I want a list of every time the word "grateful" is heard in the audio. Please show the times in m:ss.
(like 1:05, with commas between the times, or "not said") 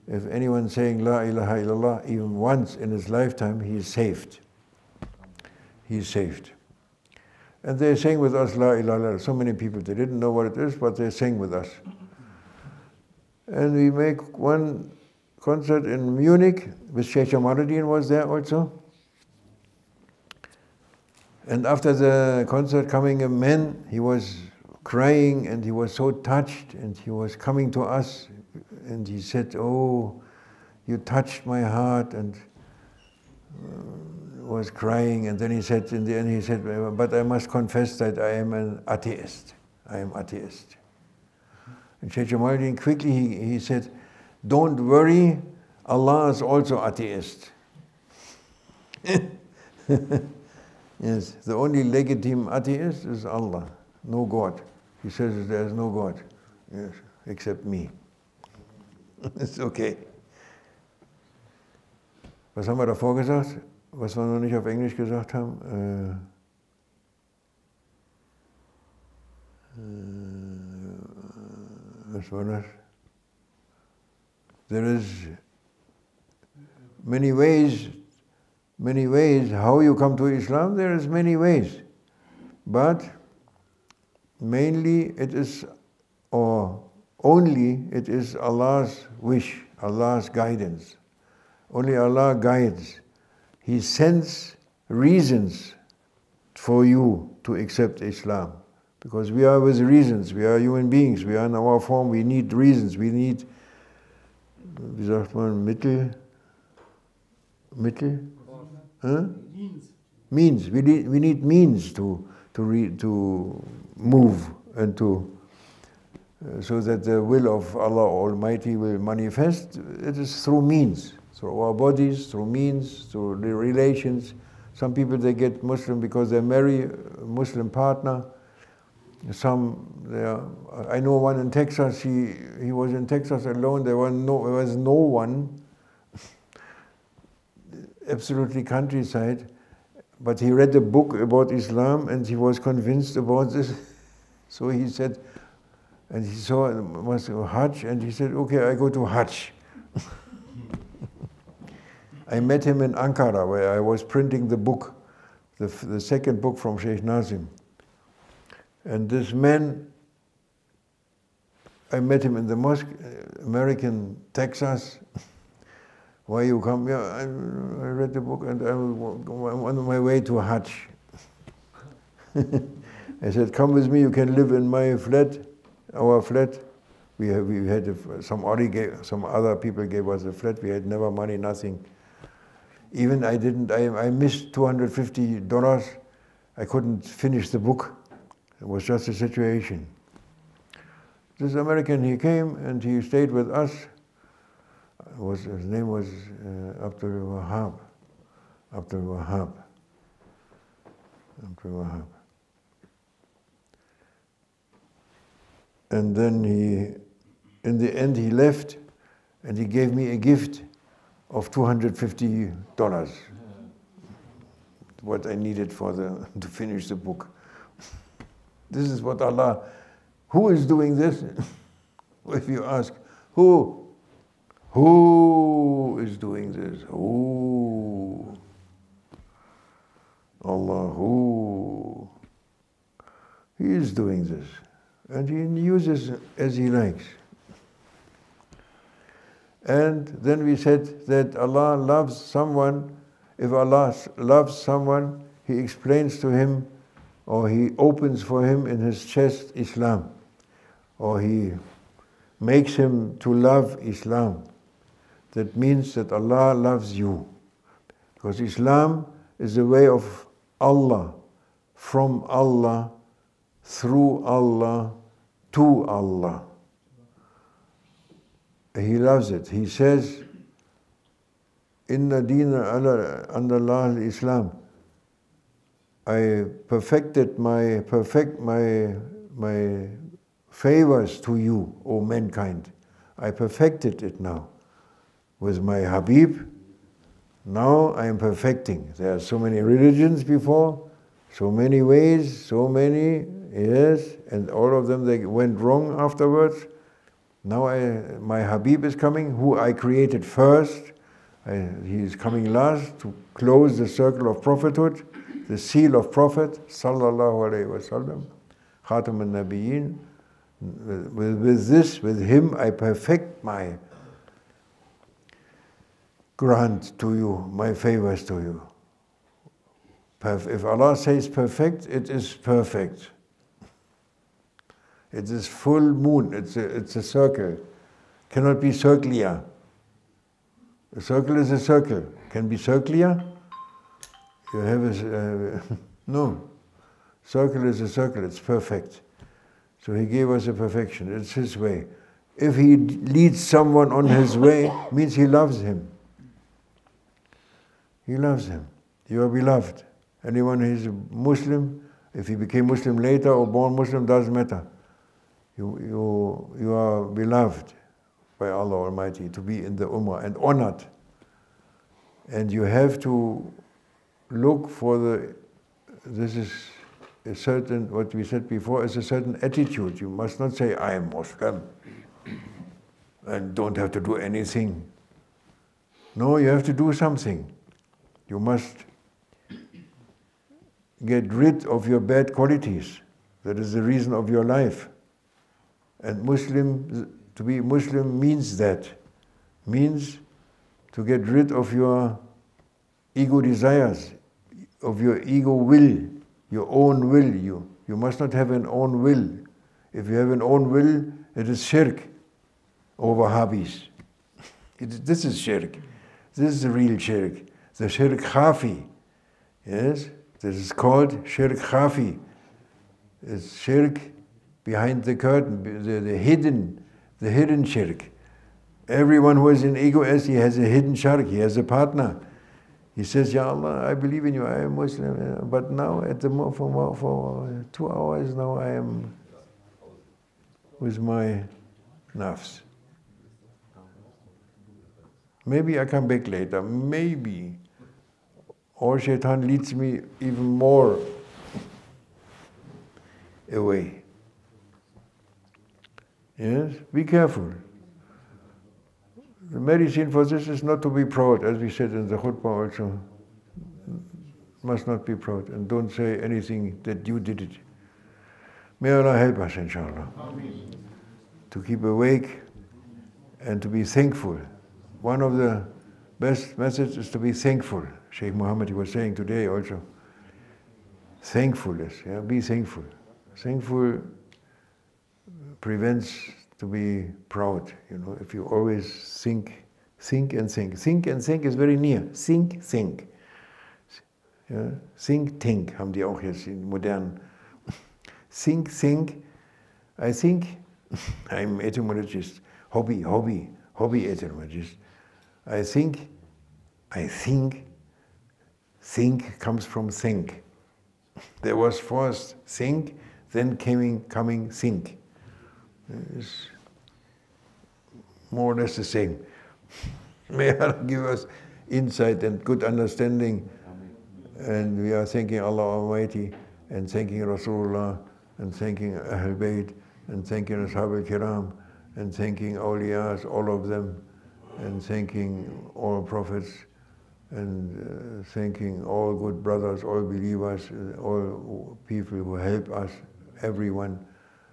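not said.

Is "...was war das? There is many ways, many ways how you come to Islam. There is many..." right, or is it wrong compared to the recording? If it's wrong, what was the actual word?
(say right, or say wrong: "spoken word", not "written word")
right.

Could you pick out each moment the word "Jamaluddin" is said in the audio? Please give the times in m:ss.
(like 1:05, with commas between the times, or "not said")
0:17, 0:42.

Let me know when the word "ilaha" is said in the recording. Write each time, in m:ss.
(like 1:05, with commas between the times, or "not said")
0:01, 0:08.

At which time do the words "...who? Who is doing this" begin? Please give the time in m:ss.
3:43.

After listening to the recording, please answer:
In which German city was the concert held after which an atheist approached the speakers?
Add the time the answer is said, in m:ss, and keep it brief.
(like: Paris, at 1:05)
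Munich, at 0:16.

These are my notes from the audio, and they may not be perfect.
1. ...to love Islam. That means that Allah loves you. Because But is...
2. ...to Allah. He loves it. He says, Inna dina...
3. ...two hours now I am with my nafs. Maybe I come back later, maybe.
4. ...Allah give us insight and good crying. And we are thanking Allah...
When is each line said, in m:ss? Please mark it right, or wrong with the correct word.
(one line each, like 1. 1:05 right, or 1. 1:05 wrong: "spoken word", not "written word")
1. 4:13 wrong: "Islam", not "But"
2. 4:25 right
3. 7:07 right
4. 8:30 wrong: "understanding", not "crying".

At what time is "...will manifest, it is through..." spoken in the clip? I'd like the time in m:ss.
1:58.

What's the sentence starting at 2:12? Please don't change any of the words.
He he was in Texas alone.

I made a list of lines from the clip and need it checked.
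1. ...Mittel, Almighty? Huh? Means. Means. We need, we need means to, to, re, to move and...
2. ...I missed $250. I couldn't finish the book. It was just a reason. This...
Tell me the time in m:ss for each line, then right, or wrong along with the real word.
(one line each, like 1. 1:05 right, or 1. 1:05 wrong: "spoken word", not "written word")
1. 1:45 wrong: "Mittel", not "Almighty"
2. 3:03 wrong: "situation", not "reason".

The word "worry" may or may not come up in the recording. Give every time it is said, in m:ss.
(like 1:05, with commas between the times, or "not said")
0:44.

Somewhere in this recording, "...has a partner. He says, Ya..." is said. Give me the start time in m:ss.
7:01.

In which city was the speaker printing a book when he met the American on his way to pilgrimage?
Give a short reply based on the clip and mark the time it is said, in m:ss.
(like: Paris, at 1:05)
Ankara, at 2:32.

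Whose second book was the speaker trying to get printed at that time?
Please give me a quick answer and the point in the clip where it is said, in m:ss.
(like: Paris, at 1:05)
Sheikh Nazim, at 2:36.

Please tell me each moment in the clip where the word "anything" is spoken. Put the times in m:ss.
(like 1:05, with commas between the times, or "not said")
6:14, 7:36.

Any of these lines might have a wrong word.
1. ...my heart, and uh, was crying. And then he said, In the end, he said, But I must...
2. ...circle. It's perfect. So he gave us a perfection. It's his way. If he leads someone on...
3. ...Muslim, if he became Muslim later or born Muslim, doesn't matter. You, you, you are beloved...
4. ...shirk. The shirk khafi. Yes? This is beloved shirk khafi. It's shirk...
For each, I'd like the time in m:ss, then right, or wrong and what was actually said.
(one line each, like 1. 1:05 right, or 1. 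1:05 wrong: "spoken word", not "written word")
1. 0:31 right
2. 5:37 right
3. 5:51 right
4. 6:46 wrong: "called", not "beloved".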